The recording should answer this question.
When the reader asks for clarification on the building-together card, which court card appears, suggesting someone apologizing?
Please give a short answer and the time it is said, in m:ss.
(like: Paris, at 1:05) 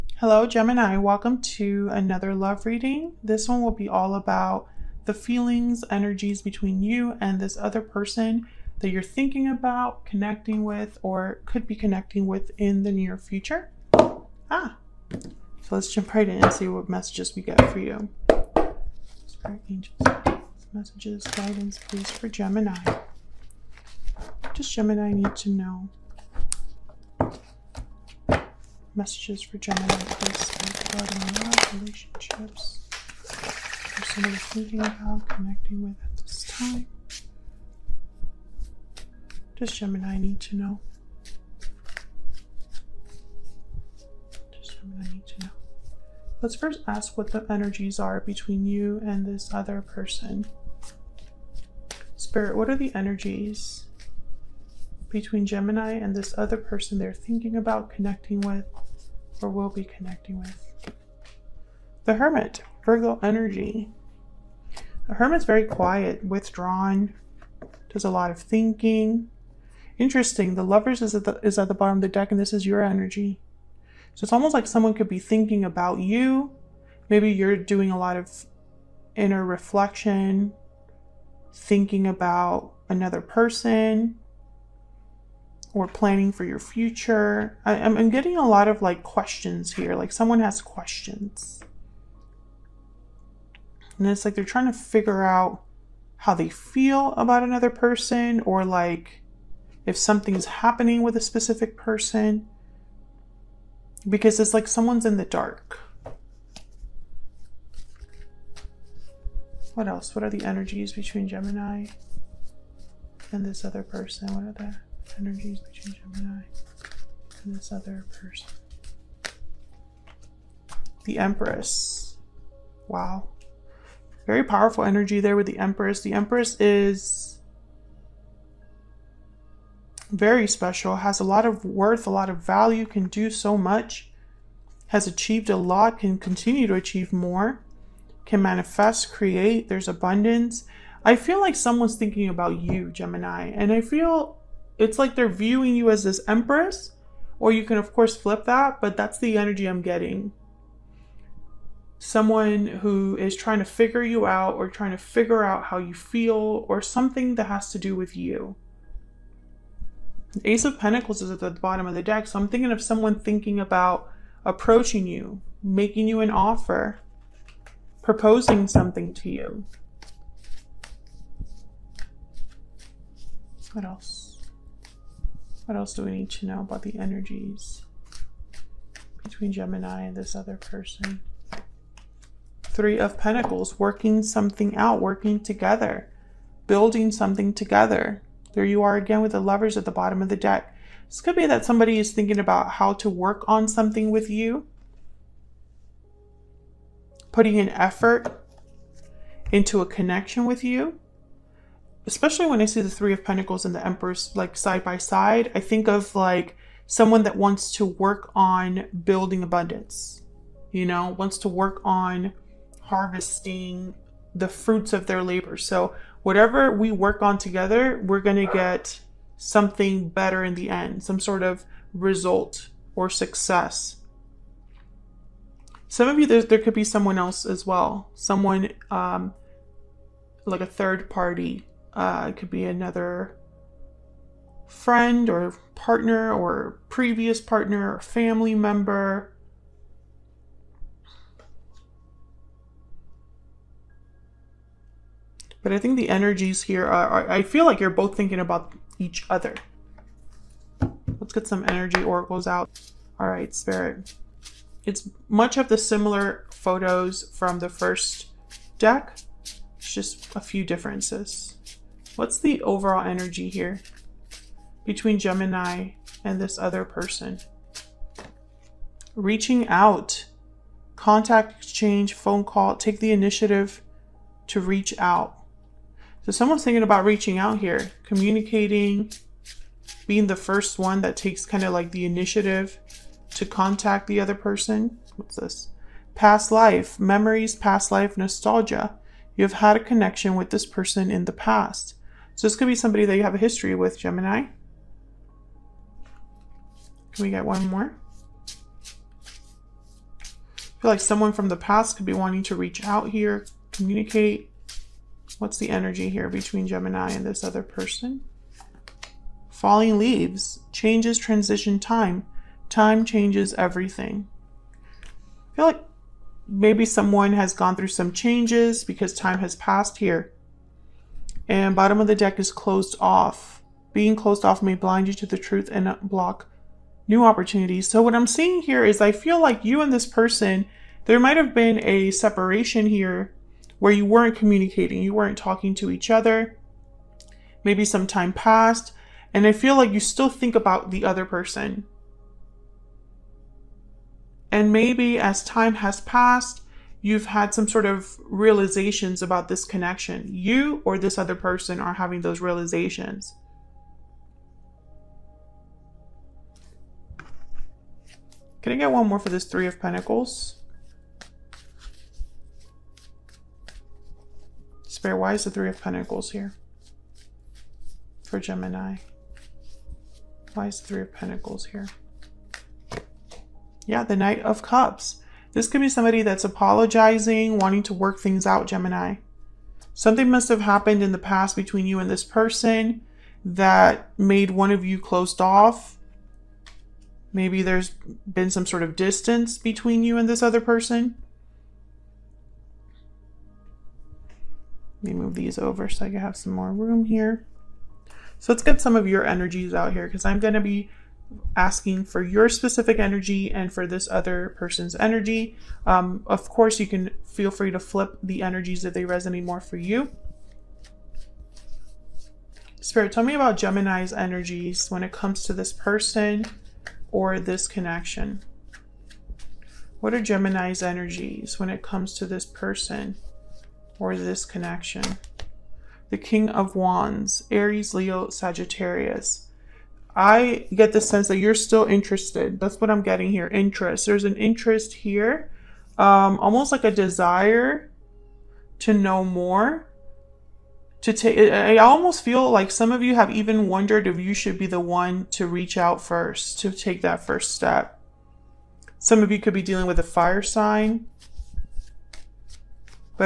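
Knight of Cups, at 6:14.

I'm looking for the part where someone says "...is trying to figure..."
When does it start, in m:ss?
2:33.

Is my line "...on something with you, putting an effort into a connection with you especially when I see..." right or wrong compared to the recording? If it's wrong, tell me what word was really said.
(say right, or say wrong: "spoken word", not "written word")
right.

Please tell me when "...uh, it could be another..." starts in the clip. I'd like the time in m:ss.
3:51.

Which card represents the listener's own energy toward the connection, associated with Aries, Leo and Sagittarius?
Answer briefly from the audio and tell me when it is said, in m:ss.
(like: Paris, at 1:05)
King of Wands, at 7:06.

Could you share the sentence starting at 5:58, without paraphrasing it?
Can I get one more for this Three of Pentacles?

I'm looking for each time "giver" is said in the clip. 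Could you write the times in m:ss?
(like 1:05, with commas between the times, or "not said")
not said.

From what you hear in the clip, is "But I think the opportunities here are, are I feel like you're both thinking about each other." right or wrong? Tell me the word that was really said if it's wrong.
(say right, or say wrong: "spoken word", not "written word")
wrong: "energies", not "opportunities".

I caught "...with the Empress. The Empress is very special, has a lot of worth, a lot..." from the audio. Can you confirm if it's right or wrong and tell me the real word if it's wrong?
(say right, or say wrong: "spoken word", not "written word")
right.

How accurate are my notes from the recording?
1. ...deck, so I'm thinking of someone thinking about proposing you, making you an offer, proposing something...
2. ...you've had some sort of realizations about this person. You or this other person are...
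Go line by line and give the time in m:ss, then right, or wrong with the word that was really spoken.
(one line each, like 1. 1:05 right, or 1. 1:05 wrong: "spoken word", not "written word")
1. 2:42 wrong: "approaching", not "proposing"
2. 5:47 wrong: "connection", not "person".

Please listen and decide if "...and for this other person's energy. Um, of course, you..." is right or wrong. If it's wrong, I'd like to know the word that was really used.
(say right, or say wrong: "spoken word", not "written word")
right.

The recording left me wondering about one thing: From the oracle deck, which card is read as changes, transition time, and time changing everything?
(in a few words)
Falling leaves.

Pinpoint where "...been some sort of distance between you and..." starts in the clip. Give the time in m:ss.
6:28.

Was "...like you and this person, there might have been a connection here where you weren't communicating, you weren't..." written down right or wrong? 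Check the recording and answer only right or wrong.
wrong.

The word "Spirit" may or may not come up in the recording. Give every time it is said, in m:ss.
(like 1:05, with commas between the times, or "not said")
0:19, 0:52, 4:13, 6:04, 6:52.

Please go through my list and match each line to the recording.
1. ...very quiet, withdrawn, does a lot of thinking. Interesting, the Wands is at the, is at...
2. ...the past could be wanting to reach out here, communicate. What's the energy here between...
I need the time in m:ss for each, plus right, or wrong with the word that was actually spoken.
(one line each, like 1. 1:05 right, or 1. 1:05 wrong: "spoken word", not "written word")
1. 1:05 wrong: "Lovers", not "Wands"
2. 5:01 right.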